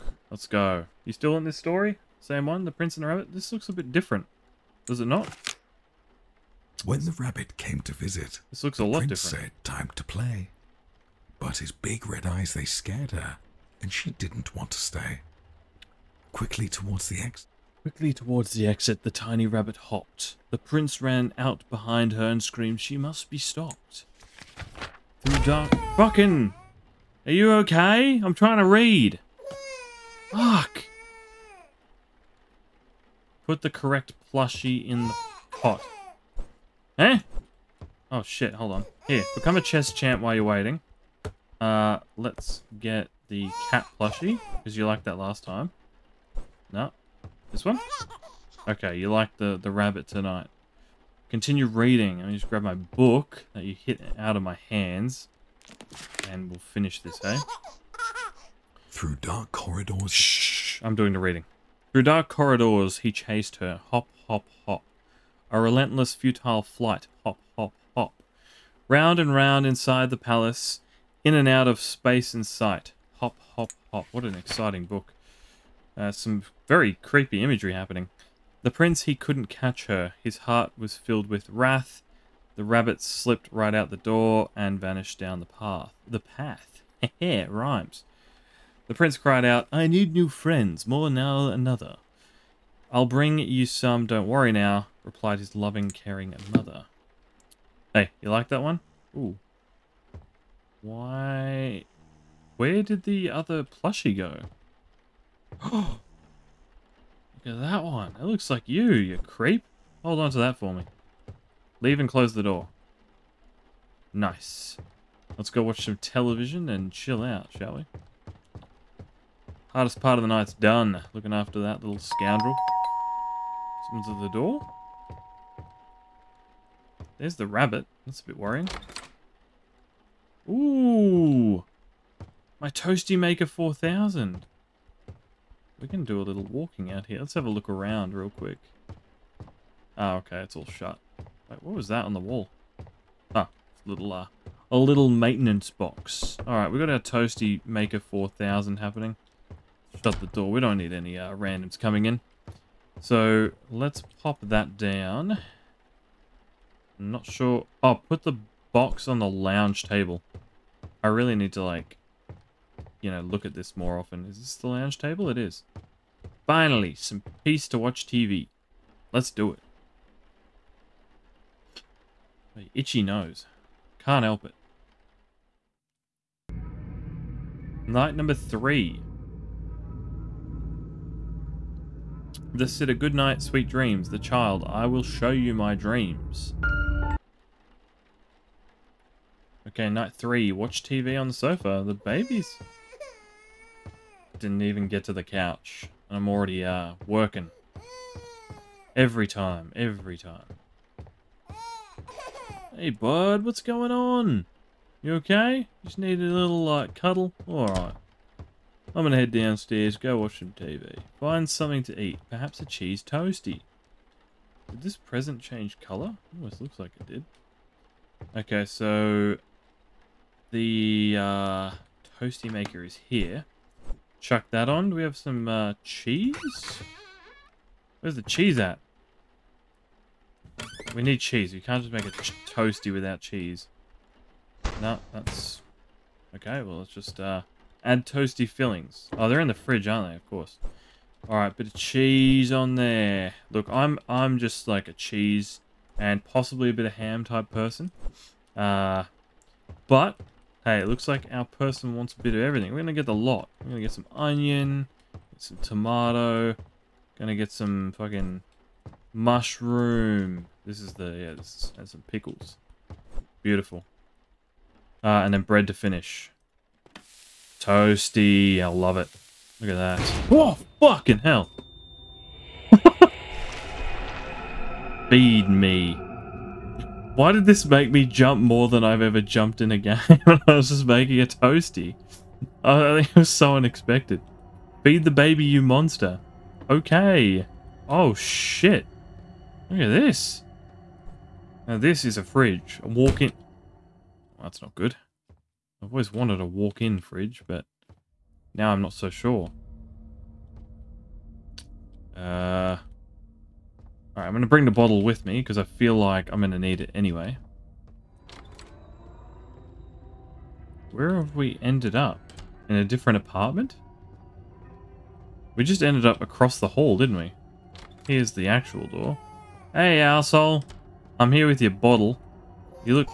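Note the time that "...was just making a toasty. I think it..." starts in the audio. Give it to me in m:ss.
4:40.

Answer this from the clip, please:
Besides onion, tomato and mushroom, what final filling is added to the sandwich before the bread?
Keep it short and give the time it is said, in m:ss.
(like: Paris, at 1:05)
pickles, at 4:22.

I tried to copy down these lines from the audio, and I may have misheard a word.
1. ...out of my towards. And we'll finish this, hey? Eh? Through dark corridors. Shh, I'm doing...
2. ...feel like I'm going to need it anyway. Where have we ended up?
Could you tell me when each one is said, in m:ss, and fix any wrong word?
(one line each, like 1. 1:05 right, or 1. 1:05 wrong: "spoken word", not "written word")
1. 0:54 wrong: "hands", not "towards"
2. 5:05 right.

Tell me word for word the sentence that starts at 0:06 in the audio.
When the rabbit came to visit, this looks a lot prince different.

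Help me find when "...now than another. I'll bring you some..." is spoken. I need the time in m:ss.
1:31.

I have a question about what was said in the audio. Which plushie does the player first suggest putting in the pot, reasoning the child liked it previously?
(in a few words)
cat plushie.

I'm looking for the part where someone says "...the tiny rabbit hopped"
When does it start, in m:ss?
0:19.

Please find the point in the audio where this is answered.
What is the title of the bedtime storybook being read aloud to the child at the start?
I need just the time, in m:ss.
0:02.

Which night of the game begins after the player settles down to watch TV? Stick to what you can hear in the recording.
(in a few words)
3.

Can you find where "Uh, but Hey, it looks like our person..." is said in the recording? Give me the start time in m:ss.
4:08.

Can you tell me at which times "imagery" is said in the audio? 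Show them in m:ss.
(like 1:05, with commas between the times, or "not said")
1:17.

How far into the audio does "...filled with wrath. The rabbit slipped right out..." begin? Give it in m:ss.
1:20.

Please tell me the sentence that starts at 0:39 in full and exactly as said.
Here, become a chess champ while you're waiting.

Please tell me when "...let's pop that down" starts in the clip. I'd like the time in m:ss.
2:33.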